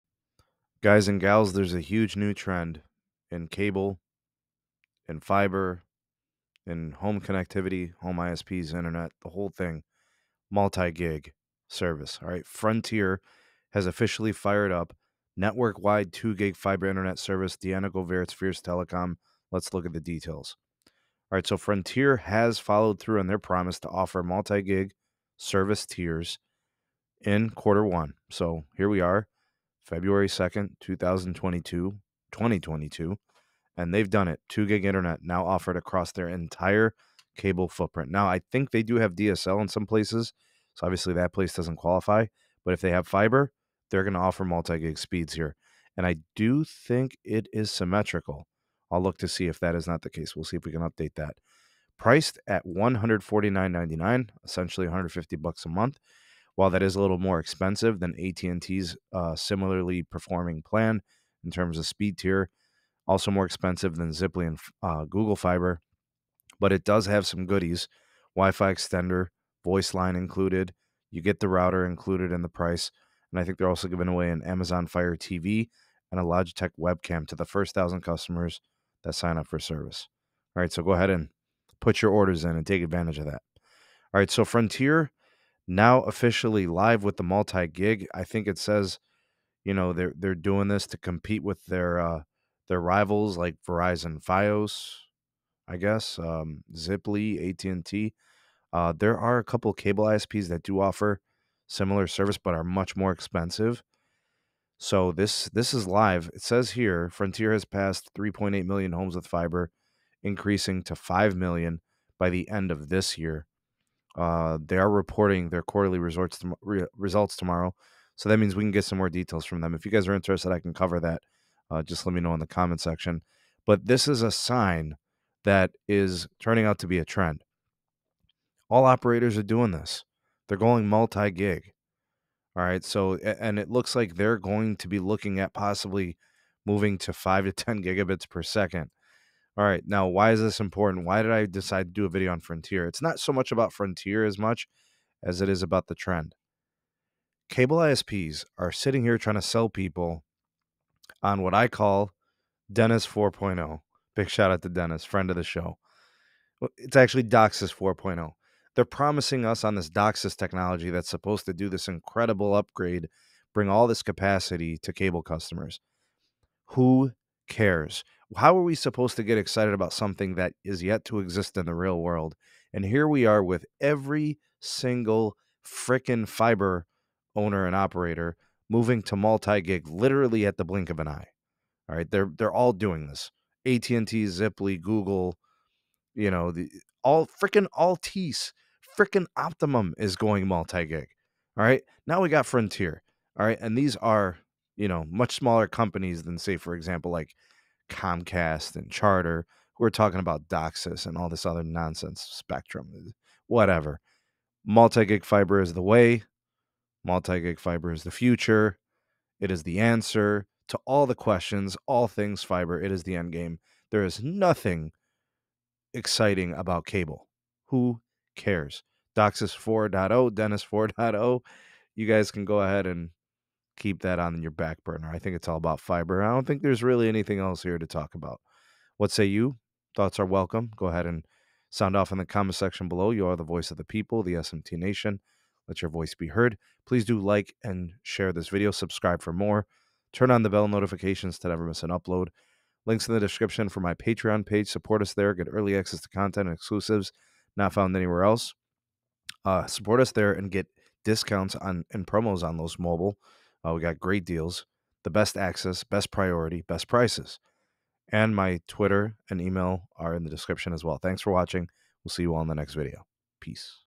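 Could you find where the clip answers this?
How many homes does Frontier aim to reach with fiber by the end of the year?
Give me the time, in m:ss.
1:50.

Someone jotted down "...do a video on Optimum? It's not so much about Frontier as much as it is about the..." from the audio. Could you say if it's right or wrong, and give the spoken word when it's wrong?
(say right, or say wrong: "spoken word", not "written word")
wrong: "Frontier", not "Optimum".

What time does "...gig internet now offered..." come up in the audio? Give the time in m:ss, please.
0:34.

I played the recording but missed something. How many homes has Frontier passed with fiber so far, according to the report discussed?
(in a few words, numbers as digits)
3.8 million.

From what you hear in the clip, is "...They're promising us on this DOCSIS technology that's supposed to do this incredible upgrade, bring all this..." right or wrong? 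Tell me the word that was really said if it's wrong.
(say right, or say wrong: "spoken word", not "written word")
right.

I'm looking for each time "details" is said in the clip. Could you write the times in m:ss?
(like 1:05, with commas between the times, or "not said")
0:20, 1:59.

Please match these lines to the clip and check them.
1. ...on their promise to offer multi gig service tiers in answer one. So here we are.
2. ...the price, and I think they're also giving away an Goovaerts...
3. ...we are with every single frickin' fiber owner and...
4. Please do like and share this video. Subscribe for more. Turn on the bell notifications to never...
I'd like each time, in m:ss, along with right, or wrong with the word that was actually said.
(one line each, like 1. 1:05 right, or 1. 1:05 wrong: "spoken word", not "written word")
1. 0:23 wrong: "quarter", not "answer"
2. 1:12 wrong: "Amazon", not "Goovaerts"
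3. 2:53 right
4. 3:56 right.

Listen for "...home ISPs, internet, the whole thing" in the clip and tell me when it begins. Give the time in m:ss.
0:08.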